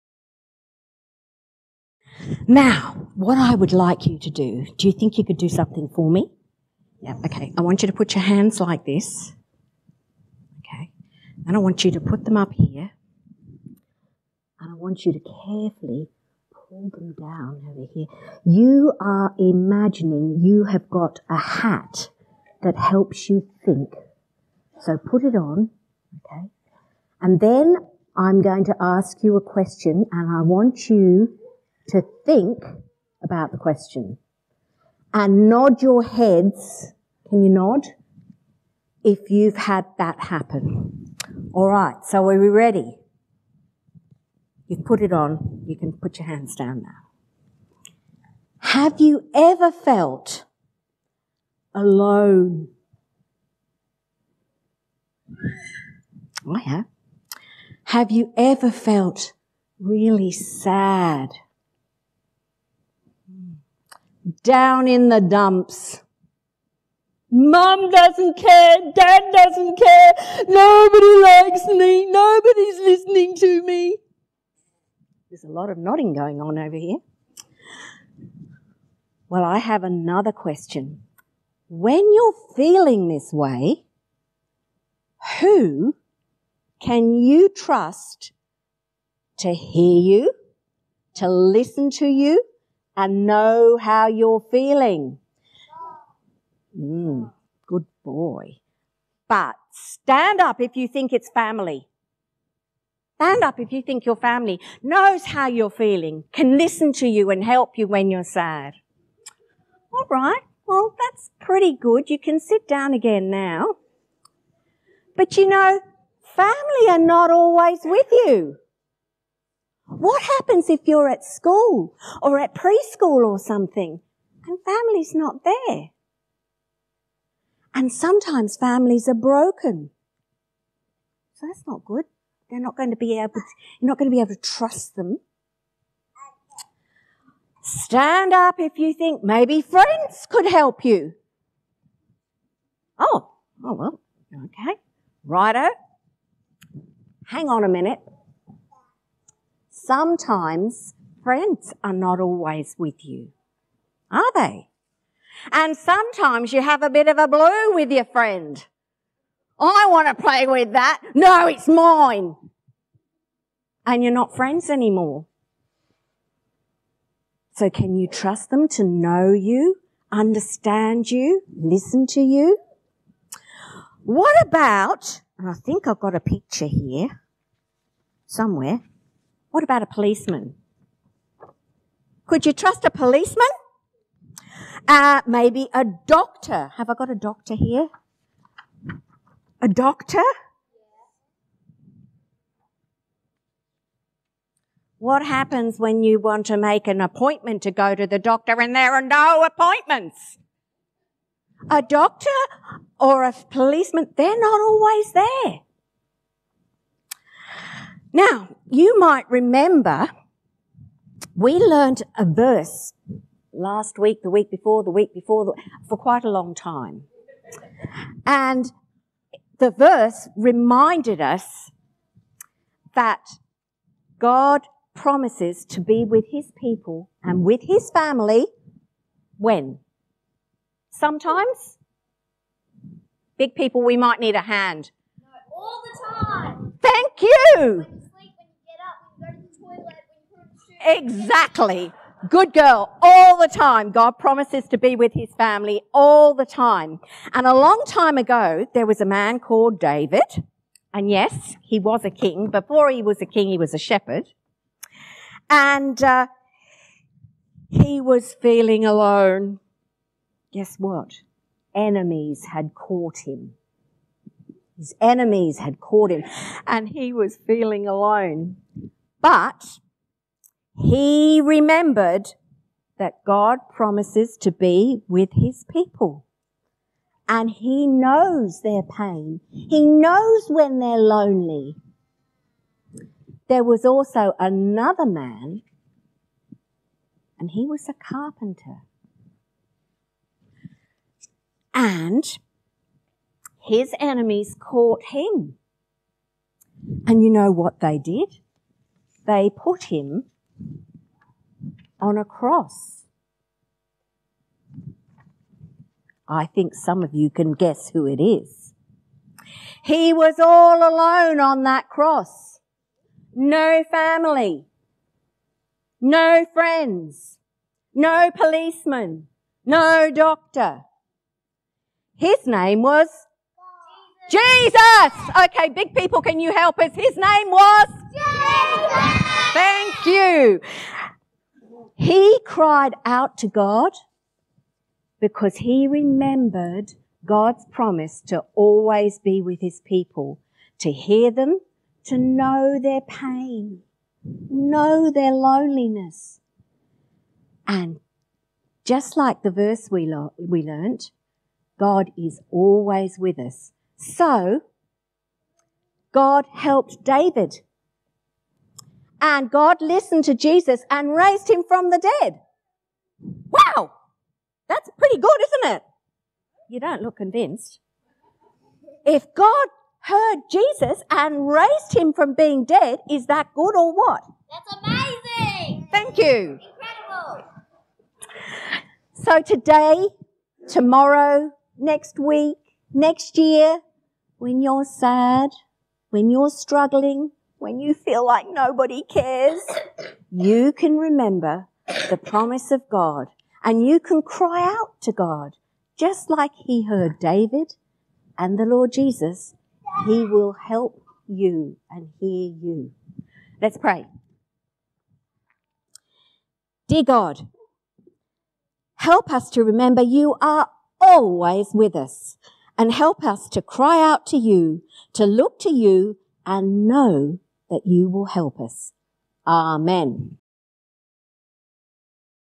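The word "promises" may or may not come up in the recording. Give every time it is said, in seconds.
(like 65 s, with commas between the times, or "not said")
224 s, 244 s, 273 s, 337 s, 392 s.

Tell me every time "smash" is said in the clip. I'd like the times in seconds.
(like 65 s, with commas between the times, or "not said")
not said.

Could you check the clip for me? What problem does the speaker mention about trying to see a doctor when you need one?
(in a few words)
No appointments.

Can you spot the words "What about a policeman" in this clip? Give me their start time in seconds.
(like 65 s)
179 s.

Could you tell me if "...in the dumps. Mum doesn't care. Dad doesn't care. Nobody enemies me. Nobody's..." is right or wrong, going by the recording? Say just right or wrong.
wrong.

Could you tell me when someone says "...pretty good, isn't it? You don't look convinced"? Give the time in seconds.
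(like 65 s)
364 s.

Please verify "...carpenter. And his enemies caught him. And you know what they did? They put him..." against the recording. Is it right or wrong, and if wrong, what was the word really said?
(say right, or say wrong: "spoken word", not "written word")
right.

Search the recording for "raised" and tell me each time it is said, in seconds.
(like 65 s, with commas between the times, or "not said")
361 s, 371 s.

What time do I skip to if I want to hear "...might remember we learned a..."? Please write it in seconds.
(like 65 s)
208 s.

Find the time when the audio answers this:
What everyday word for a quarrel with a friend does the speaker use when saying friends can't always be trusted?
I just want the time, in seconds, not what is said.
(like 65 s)
156 s.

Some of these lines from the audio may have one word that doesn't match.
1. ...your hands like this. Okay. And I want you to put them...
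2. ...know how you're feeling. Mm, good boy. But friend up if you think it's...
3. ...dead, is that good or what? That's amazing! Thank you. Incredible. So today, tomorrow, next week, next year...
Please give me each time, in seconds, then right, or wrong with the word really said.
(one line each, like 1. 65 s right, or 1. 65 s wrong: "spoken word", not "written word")
1. 8 s right
2. 93 s wrong: "stand", not "friend"
3. 372 s right.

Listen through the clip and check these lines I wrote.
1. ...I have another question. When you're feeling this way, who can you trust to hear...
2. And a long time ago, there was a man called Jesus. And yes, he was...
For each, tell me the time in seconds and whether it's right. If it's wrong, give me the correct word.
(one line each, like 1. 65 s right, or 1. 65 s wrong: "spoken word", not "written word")
1. 79 s right
2. 247 s wrong: "David", not "Jesus".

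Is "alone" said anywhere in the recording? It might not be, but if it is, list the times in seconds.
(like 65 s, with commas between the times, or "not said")
51 s, 258 s, 267 s, 310 s.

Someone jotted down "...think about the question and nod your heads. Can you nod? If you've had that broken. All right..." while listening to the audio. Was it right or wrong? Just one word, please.
wrong.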